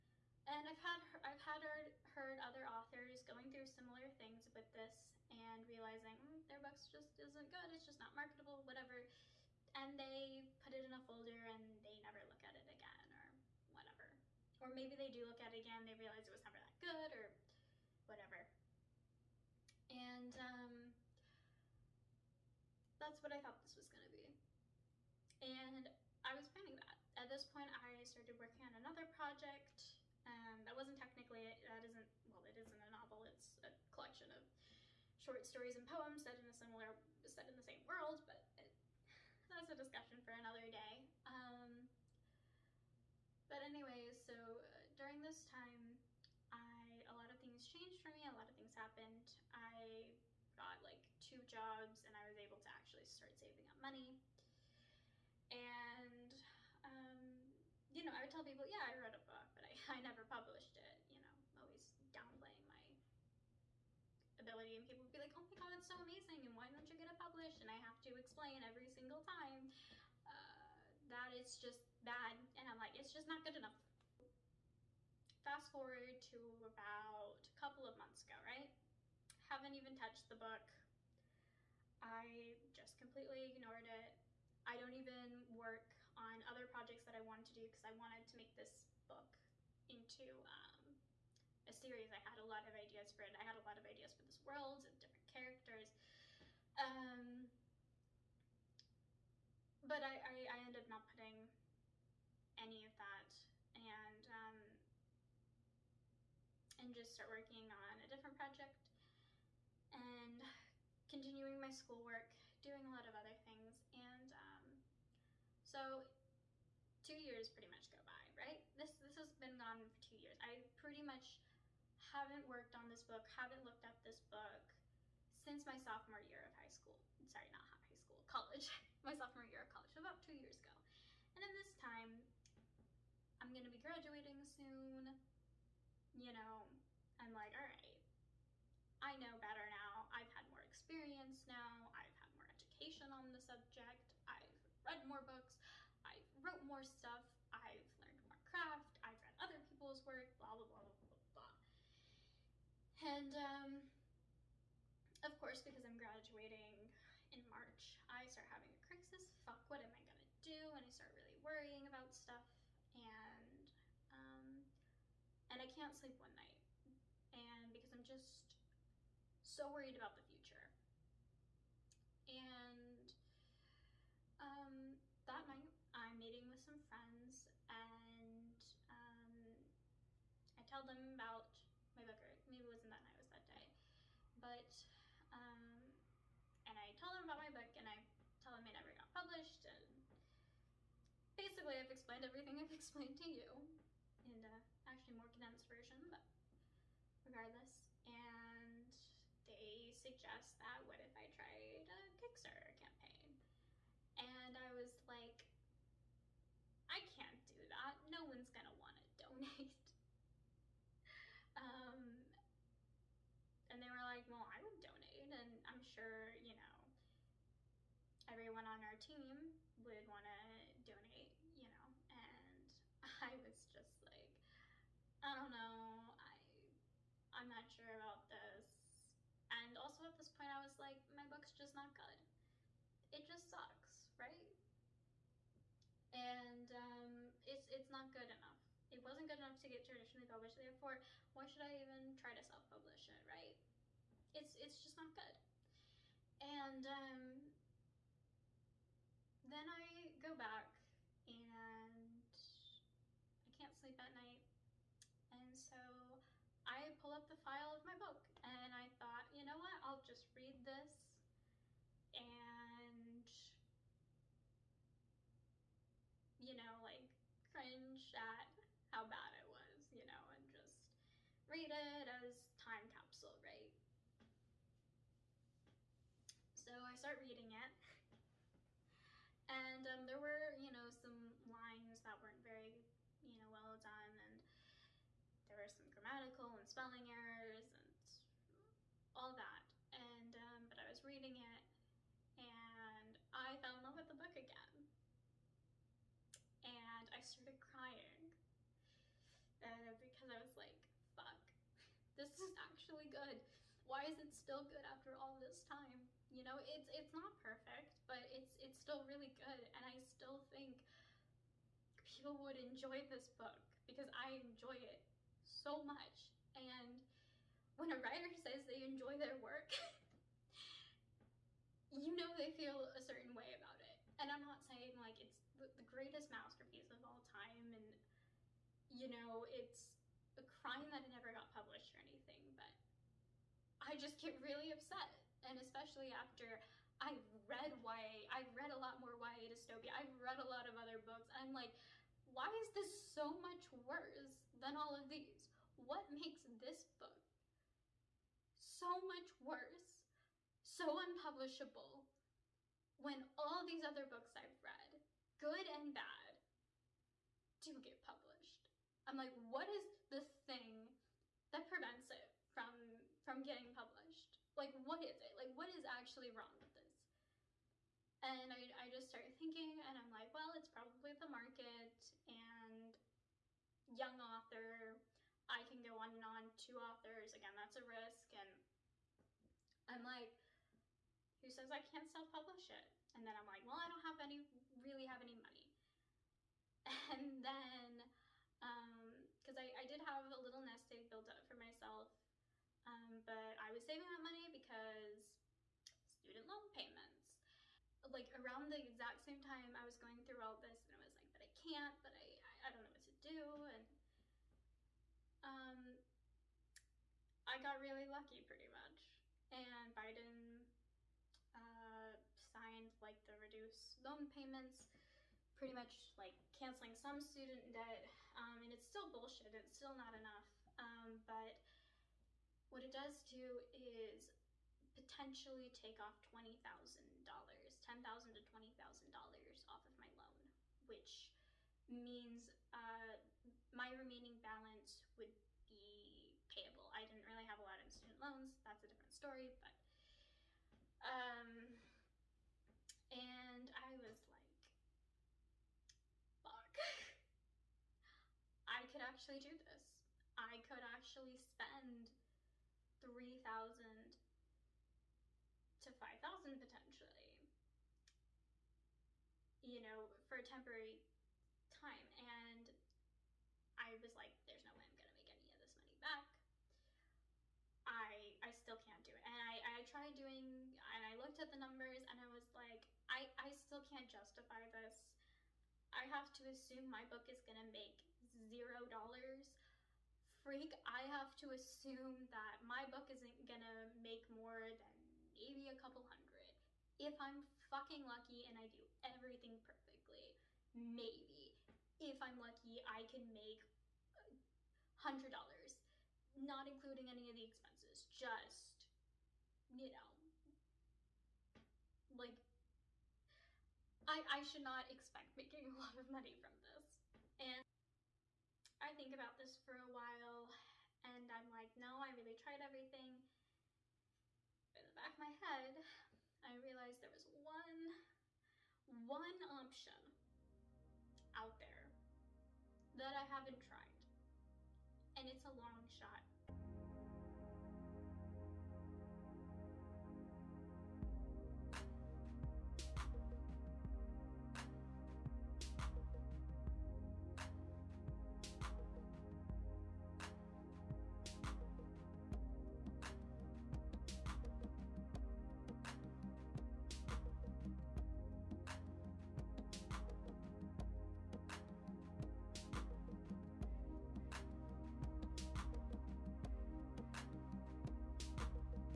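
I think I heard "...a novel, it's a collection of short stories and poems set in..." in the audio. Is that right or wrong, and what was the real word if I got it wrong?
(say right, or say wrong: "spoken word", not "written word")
right.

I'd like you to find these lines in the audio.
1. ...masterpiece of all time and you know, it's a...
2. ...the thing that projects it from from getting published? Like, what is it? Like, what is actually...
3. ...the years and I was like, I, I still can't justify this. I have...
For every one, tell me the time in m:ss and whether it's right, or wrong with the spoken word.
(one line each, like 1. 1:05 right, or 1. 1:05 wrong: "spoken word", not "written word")
1. 5:26 right
2. 6:00 wrong: "prevents", not "projects"
3. 7:51 wrong: "numbers", not "years".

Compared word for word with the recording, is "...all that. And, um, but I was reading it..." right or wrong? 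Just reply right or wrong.
right.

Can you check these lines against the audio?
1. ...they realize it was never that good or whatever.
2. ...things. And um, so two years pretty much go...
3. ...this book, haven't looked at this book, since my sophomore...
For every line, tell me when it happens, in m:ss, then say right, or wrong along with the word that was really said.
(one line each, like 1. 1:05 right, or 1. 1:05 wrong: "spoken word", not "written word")
1. 0:15 right
2. 1:53 right
3. 2:02 right.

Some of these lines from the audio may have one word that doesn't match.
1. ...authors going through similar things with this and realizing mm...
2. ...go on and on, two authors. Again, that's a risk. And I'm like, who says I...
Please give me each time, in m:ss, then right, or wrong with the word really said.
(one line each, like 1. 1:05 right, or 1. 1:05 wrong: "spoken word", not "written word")
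1. 0:02 right
2. 6:15 right.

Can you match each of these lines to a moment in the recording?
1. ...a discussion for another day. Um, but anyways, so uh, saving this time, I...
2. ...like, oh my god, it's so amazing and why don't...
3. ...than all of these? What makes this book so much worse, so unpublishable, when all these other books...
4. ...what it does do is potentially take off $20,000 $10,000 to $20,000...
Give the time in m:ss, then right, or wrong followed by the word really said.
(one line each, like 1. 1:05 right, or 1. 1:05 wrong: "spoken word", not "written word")
1. 0:39 wrong: "during", not "saving"
2. 1:05 right
3. 5:44 right
4. 7:02 right.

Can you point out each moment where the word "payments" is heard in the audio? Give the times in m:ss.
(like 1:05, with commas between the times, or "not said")
6:36, 6:54.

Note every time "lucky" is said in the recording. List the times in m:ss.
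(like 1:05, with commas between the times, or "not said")
6:48, 8:08, 8:12.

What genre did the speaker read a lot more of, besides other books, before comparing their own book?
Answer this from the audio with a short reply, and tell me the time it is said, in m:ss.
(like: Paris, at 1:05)
YA dystopia, at 5:39.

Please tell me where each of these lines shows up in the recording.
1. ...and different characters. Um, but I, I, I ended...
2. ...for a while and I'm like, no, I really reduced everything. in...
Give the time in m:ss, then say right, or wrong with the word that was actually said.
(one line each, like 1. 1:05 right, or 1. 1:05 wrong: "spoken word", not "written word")
1. 1:34 right
2. 8:29 wrong: "tried", not "reduced".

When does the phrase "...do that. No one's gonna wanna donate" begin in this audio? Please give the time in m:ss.
3:27.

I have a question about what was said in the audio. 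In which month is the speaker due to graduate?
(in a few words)
March.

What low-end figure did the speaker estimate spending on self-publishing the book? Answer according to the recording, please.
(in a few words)
3,000.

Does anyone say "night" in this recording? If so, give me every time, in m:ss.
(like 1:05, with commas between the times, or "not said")
2:46, 2:55, 3:03, 4:14.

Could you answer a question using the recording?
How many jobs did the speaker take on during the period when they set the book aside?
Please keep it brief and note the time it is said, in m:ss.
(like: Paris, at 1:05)
2, at 0:51.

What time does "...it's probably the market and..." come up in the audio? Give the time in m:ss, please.
6:10.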